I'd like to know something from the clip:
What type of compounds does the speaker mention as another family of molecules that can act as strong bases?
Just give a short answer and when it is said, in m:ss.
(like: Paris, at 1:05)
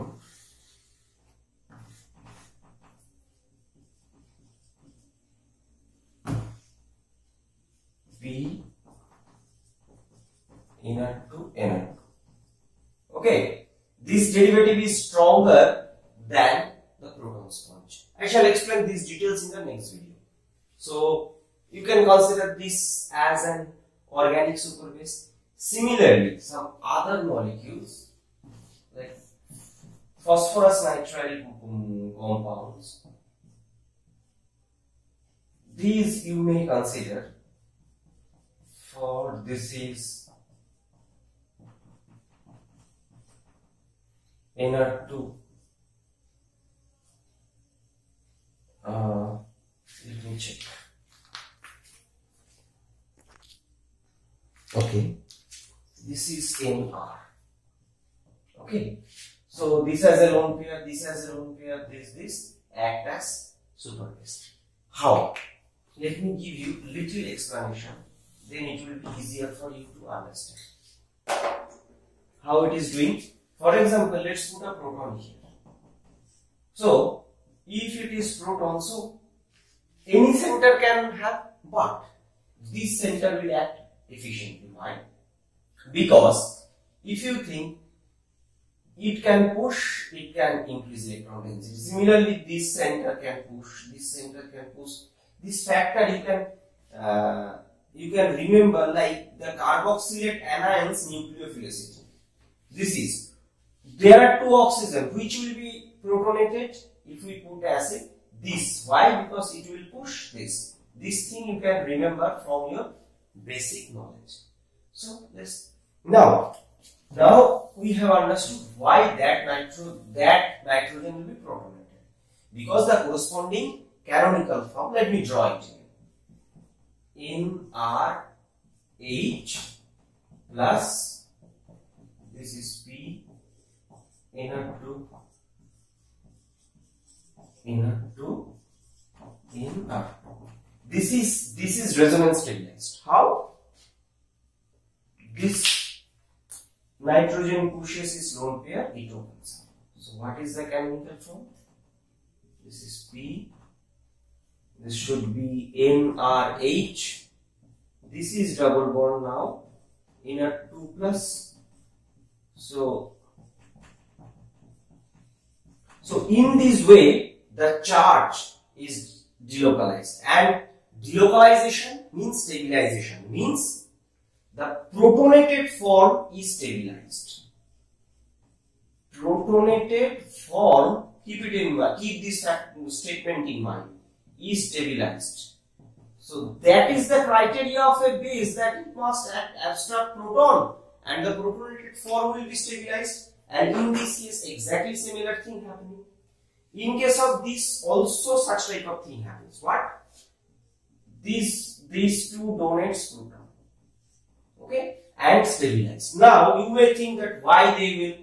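phosphorus nitrile compounds, at 0:30.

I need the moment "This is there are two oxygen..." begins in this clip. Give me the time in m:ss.
1:42.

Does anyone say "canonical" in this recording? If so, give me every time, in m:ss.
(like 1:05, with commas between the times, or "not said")
2:04.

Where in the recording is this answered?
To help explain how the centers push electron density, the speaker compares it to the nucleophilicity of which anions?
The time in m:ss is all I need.
1:39.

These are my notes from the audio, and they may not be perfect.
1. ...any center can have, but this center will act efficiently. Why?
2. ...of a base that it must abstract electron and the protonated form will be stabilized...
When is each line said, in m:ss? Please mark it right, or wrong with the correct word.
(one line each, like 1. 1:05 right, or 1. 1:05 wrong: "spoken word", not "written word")
1. 1:20 right
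2. 3:07 wrong: "proton", not "electron".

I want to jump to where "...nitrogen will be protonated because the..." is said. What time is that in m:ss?
2:00.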